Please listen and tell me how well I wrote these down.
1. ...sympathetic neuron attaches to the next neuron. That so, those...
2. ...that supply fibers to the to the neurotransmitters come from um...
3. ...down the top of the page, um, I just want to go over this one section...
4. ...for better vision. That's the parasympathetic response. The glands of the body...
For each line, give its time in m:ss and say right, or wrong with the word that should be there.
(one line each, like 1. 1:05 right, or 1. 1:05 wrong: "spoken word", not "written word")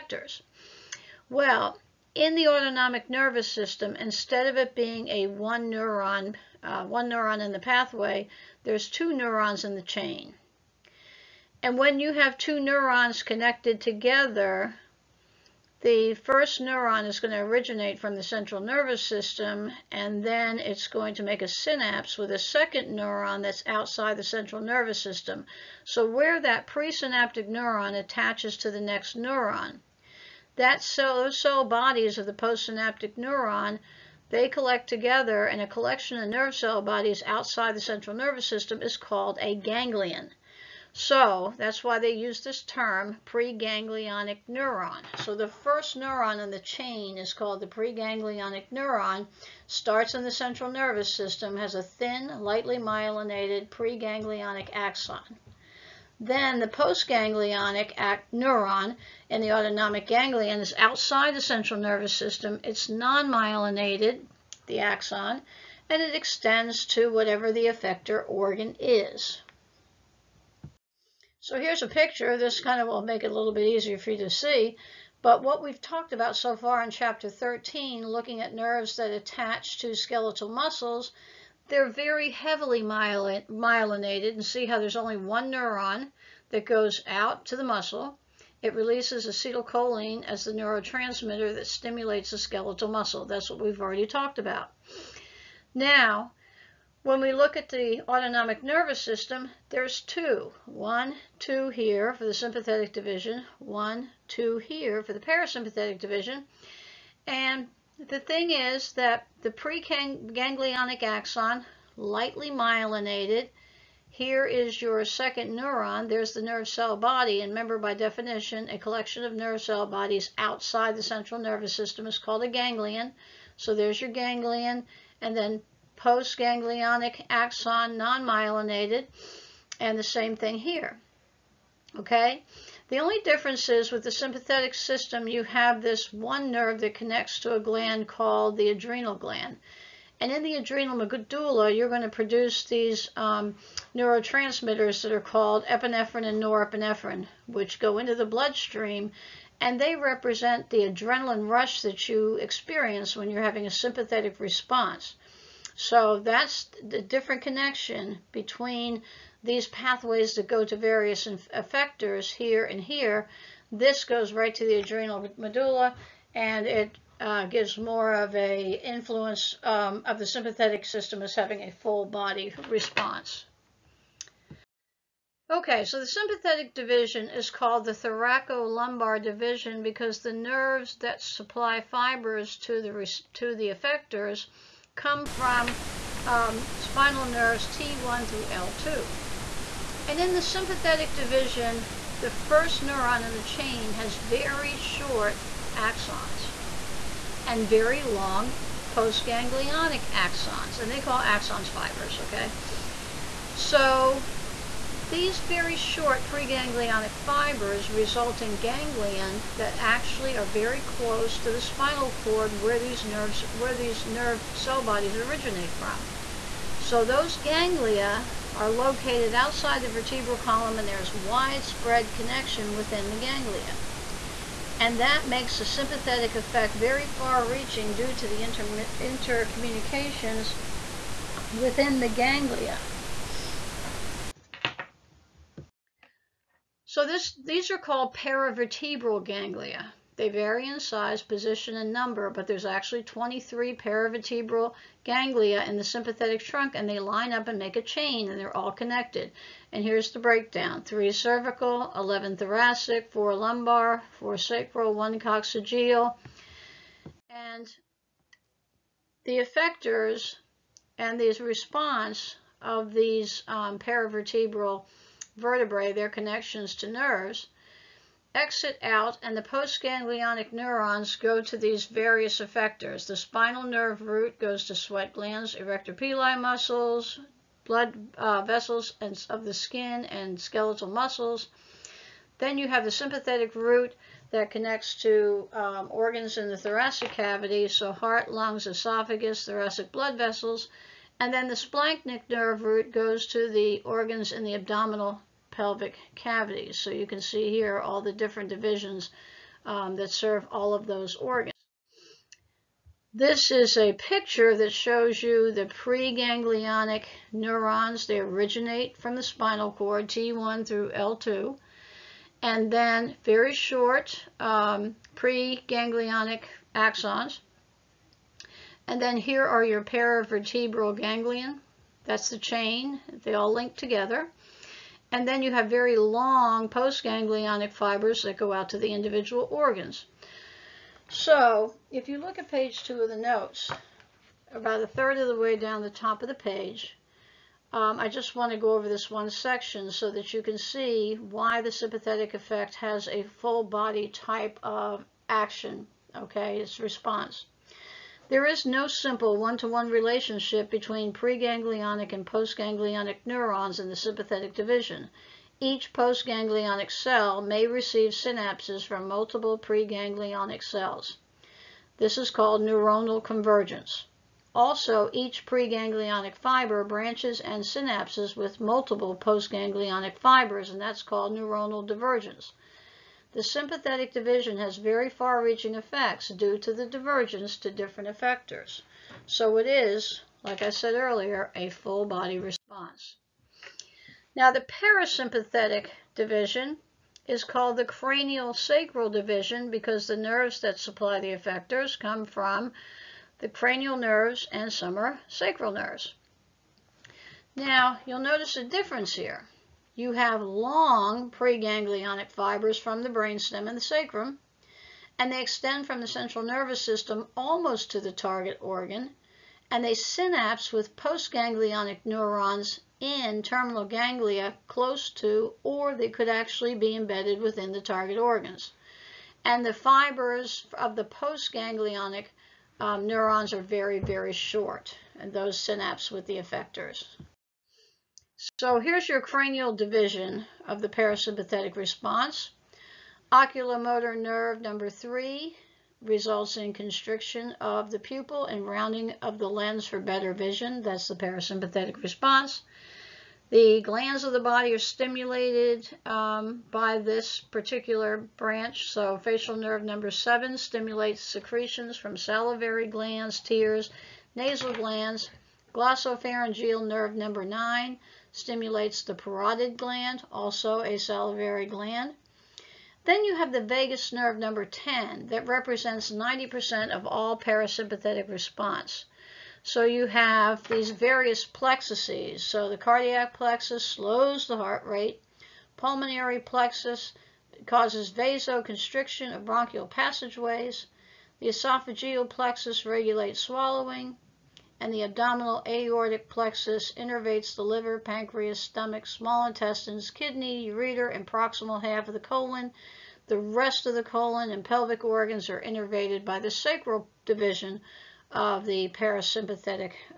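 1. 0:26 wrong: "presynaptic", not "sympathetic"
2. 3:00 wrong: "effectors", not "neurotransmitters"
3. 5:35 right
4. 7:19 right.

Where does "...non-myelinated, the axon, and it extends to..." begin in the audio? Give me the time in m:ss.
1:02.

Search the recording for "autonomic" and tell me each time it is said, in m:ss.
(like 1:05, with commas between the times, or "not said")
0:02, 0:59, 1:38.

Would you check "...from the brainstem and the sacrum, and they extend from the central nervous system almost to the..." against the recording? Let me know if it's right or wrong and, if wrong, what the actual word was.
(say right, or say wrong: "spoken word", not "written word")
right.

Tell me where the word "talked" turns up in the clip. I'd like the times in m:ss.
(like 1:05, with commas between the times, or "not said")
1:15, 1:34.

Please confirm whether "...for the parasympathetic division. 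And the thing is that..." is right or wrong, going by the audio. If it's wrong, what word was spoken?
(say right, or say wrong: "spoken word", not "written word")
right.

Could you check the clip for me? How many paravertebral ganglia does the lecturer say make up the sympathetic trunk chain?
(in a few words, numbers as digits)
23.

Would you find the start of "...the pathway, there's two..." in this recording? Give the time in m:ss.
0:07.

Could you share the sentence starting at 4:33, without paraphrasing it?
The spinal nerve root goes to sweat glands, arrector pili muscles, blood uh, vessels and of the skin and skeletal muscles.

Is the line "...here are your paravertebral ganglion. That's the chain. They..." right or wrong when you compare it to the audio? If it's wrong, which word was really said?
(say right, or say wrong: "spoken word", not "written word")
right.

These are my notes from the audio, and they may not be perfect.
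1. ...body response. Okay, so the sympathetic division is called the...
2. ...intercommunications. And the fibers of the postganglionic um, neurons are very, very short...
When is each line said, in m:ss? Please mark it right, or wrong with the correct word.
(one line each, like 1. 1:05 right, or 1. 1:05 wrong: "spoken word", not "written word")
1. 2:52 right
2. 6:58 wrong: "organs", not "intercommunications".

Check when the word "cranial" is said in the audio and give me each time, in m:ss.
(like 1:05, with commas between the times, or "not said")
6:27, 6:33, 7:09.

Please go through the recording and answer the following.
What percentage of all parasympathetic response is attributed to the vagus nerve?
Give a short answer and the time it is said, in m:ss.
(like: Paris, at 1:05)
90%, at 7:46.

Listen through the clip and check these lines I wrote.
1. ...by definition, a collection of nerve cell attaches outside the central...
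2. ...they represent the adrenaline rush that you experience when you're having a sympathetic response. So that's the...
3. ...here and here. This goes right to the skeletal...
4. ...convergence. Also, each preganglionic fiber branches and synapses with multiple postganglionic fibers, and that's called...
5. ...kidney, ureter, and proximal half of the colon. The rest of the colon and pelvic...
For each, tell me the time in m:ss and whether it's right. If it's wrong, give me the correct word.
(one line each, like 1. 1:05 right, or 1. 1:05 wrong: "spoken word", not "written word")
1. 1:57 wrong: "bodies", not "attaches"
2. 2:29 right
3. 2:42 wrong: "adrenal", not "skeletal"
4. 6:03 right
5. 8:10 right.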